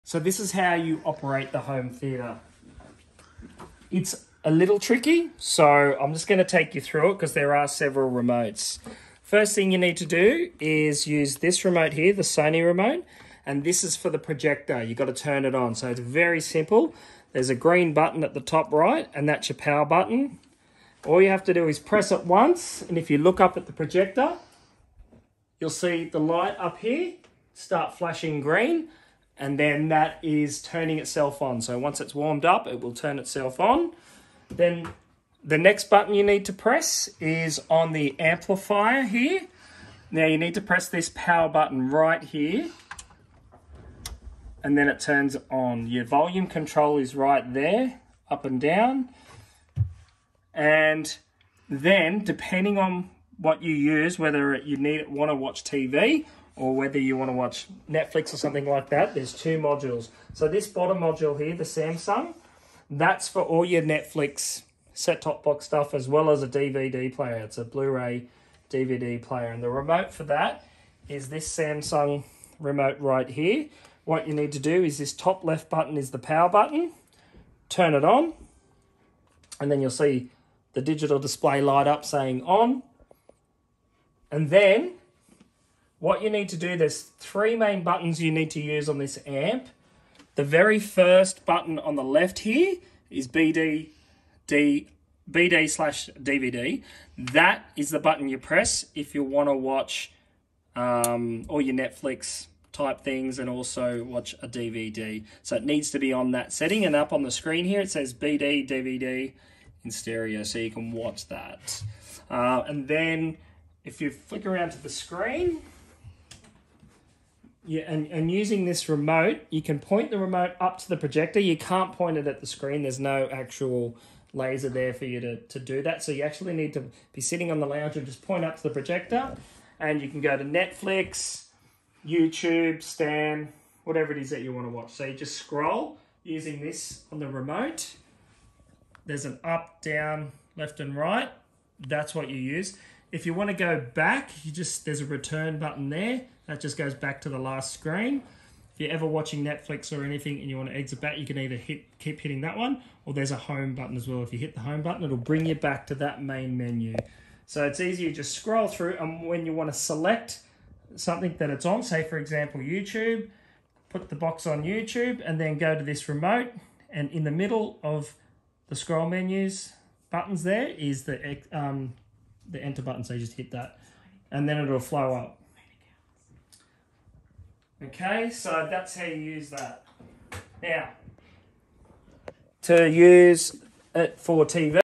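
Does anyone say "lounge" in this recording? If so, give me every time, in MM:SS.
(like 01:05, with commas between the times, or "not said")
02:07.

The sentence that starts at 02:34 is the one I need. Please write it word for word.
If you hit the home button, it'll bring you back to that main menu.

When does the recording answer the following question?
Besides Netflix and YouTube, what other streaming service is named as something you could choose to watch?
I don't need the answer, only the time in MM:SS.
02:12.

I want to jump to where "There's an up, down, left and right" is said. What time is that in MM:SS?
02:19.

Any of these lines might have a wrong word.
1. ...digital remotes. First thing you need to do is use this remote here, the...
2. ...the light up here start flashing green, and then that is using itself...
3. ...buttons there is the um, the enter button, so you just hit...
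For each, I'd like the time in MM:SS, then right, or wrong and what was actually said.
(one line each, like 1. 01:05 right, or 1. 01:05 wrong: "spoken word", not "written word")
1. 00:07 wrong: "several", not "digital"
2. 00:26 wrong: "turning", not "using"
3. 02:50 right.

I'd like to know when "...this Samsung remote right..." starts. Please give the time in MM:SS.
01:11.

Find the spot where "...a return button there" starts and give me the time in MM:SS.
02:25.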